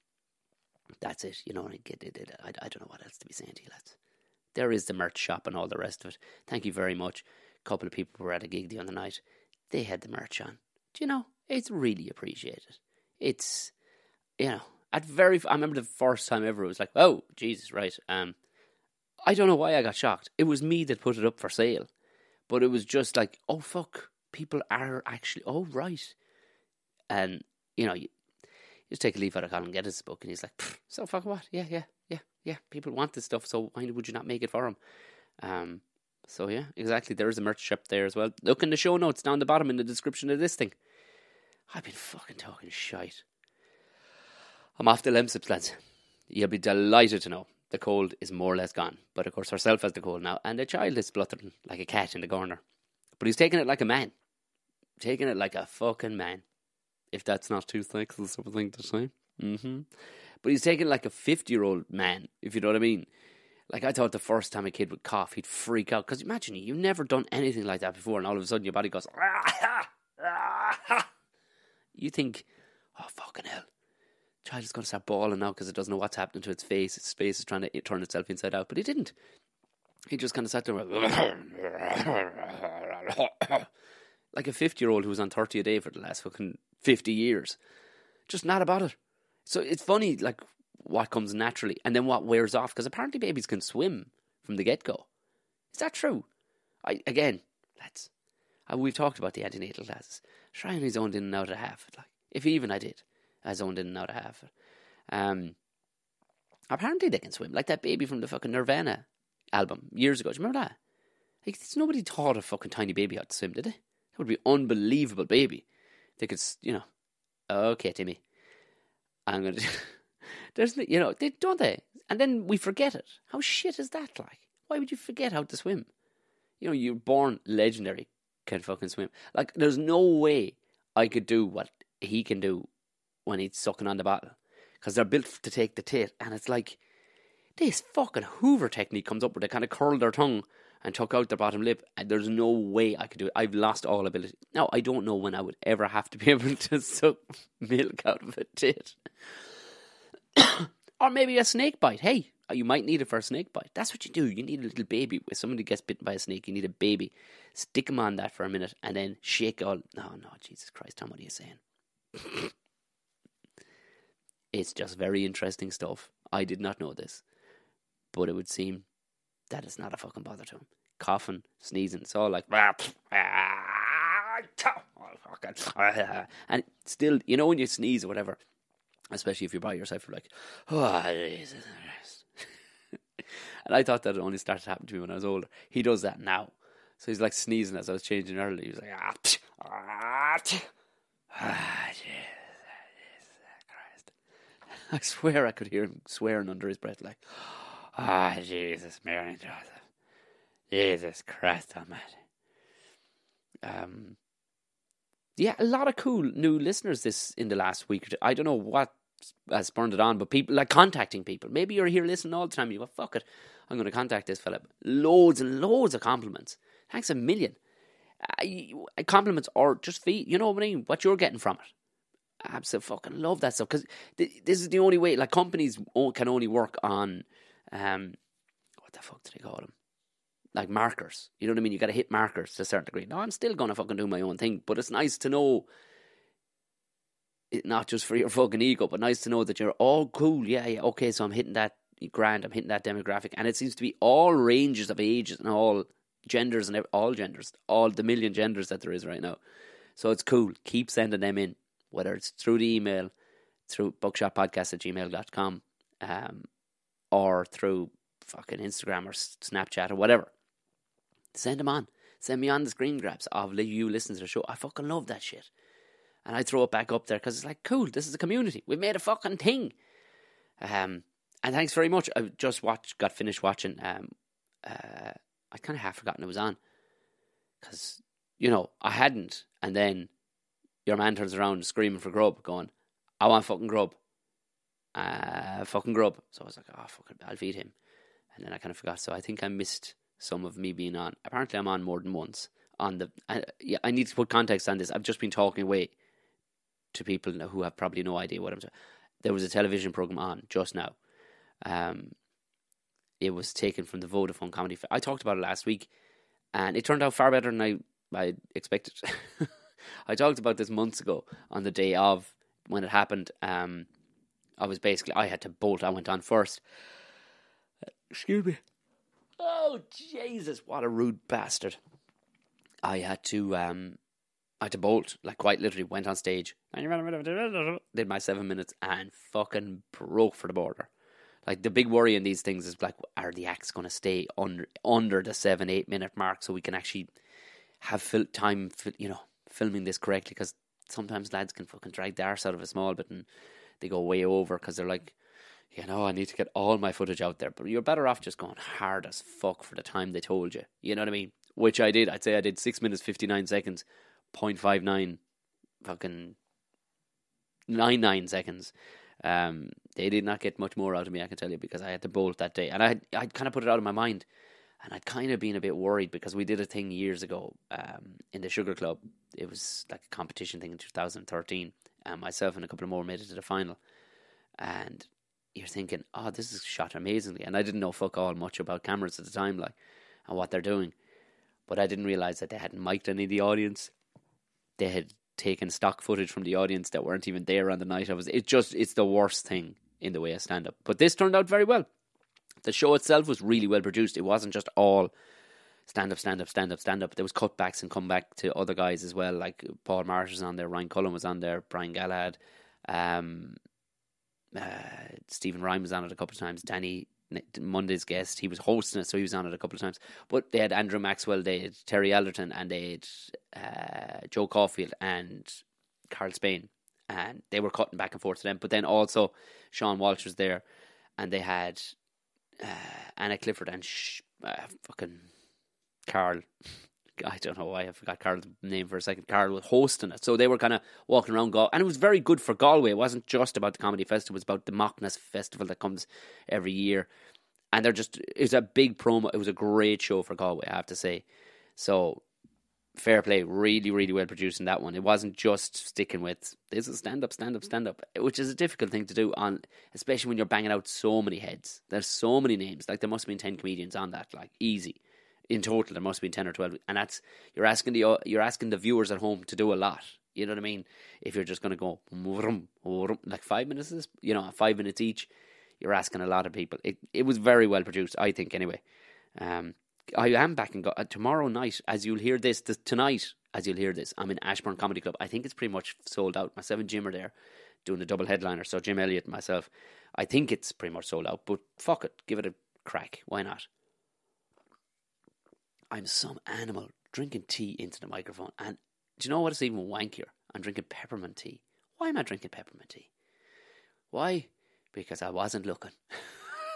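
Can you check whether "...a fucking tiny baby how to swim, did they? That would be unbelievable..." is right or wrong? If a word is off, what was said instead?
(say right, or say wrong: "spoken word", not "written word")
right.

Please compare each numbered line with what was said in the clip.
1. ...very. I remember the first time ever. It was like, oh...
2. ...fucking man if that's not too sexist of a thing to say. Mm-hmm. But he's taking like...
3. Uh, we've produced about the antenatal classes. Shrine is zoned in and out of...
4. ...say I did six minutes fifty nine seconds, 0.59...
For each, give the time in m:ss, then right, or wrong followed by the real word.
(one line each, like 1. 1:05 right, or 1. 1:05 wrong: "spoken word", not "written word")
1. 0:15 right
2. 0:55 right
3. 1:38 wrong: "talked", not "produced"
4. 5:52 right.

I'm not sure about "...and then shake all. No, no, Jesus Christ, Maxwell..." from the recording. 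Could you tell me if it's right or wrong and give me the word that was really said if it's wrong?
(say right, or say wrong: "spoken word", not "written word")
wrong: "Tom", not "Maxwell".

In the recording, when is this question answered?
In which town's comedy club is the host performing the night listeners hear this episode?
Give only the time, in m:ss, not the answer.
7:54.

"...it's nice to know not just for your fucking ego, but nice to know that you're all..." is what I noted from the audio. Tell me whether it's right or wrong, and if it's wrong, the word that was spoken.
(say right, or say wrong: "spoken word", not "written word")
right.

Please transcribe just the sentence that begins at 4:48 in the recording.
So I think I missed some of me being on.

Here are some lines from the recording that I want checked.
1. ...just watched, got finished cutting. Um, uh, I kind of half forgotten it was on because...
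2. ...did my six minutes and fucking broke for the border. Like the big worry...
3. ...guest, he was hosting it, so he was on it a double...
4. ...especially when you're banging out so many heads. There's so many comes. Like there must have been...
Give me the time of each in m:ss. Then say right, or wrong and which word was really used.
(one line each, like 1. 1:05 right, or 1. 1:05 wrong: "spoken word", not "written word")
1. 4:32 wrong: "watching", not "cutting"
2. 5:27 wrong: "seven", not "six"
3. 6:48 wrong: "couple", not "double"
4. 7:29 wrong: "names", not "comes".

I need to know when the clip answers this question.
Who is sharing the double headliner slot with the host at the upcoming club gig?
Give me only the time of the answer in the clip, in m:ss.
7:58.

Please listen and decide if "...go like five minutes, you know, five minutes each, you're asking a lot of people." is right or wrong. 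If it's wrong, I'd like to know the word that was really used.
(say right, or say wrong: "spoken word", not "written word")
right.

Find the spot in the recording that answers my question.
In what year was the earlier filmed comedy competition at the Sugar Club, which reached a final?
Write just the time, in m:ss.
6:10.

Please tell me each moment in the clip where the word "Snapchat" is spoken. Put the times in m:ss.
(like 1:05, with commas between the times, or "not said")
4:19.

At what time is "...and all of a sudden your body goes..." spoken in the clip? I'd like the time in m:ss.
1:08.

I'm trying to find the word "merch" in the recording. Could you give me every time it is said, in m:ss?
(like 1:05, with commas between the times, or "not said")
0:04, 0:10, 0:37.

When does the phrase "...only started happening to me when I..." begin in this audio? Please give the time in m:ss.
3:04.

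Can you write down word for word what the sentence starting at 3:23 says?
Um, yeah, a lot of cool new listeners this in the last week.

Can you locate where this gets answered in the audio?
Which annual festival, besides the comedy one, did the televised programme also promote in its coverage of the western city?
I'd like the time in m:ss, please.
7:14.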